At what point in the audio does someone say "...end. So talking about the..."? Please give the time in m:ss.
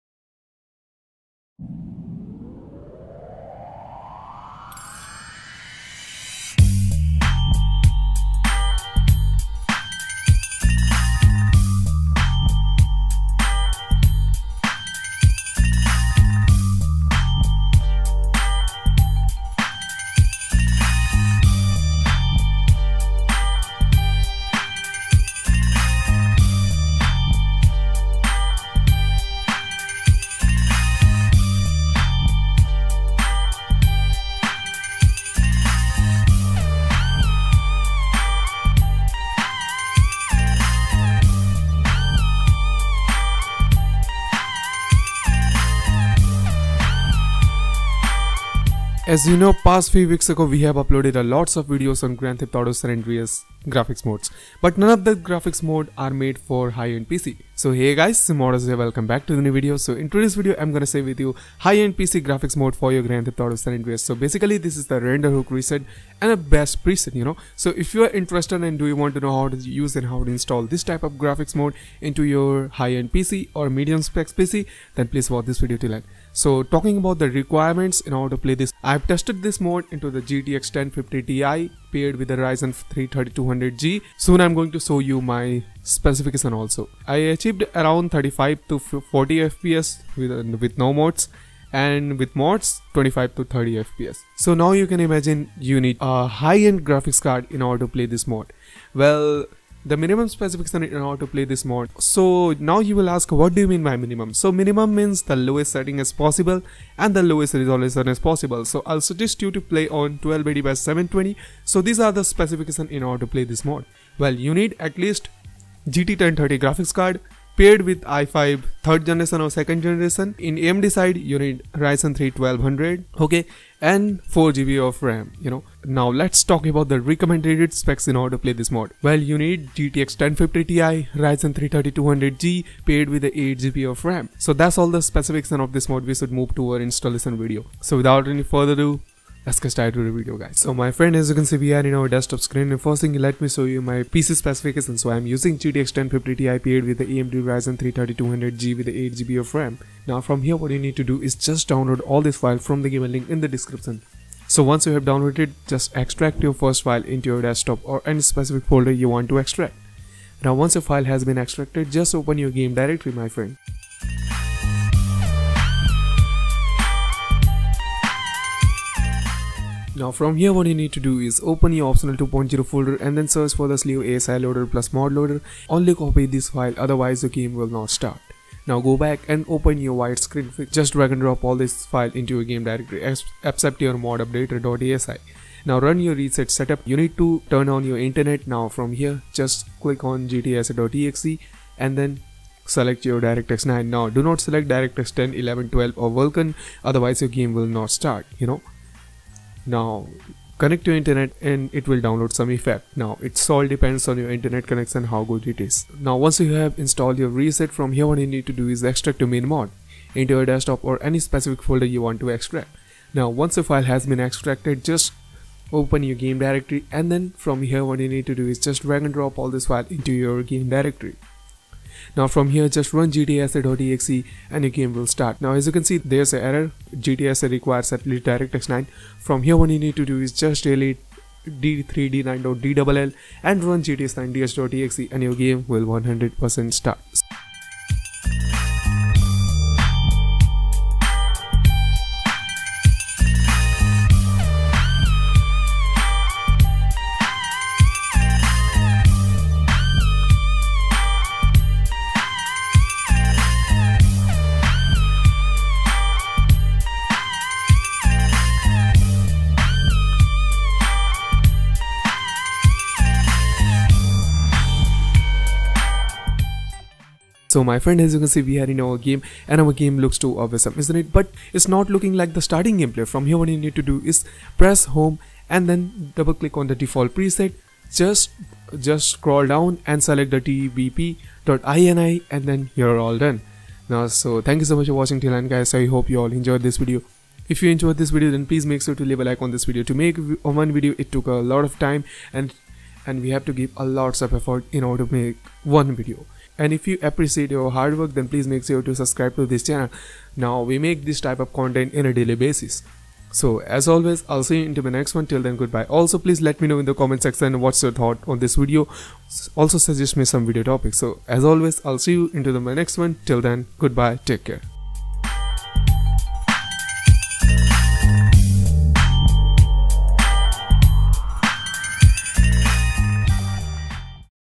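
1:15.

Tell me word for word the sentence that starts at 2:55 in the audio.
Only copy this file otherwise the game will not start.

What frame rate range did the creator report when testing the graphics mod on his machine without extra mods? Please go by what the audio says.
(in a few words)
35 to 40 FPS.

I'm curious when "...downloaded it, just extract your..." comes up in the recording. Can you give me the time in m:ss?
2:35.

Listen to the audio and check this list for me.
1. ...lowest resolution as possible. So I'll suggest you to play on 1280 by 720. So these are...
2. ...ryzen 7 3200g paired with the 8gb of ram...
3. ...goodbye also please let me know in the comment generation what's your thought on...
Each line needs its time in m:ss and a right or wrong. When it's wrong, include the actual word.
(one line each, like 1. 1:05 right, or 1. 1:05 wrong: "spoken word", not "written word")
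1. 1:47 right
2. 2:11 wrong: "3", not "7"
3. 5:05 wrong: "section", not "generation".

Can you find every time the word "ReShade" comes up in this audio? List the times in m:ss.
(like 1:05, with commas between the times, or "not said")
1:05, 3:06, 3:27.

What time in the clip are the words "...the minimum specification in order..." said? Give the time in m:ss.
1:39.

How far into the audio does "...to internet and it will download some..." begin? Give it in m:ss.
3:20.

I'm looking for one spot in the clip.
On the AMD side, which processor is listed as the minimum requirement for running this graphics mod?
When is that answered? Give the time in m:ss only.
2:01.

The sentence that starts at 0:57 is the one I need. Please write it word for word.
So hey guys, Simodus here, welcome back to the new video.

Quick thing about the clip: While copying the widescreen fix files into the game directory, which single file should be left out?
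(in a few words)
mod updater.asi.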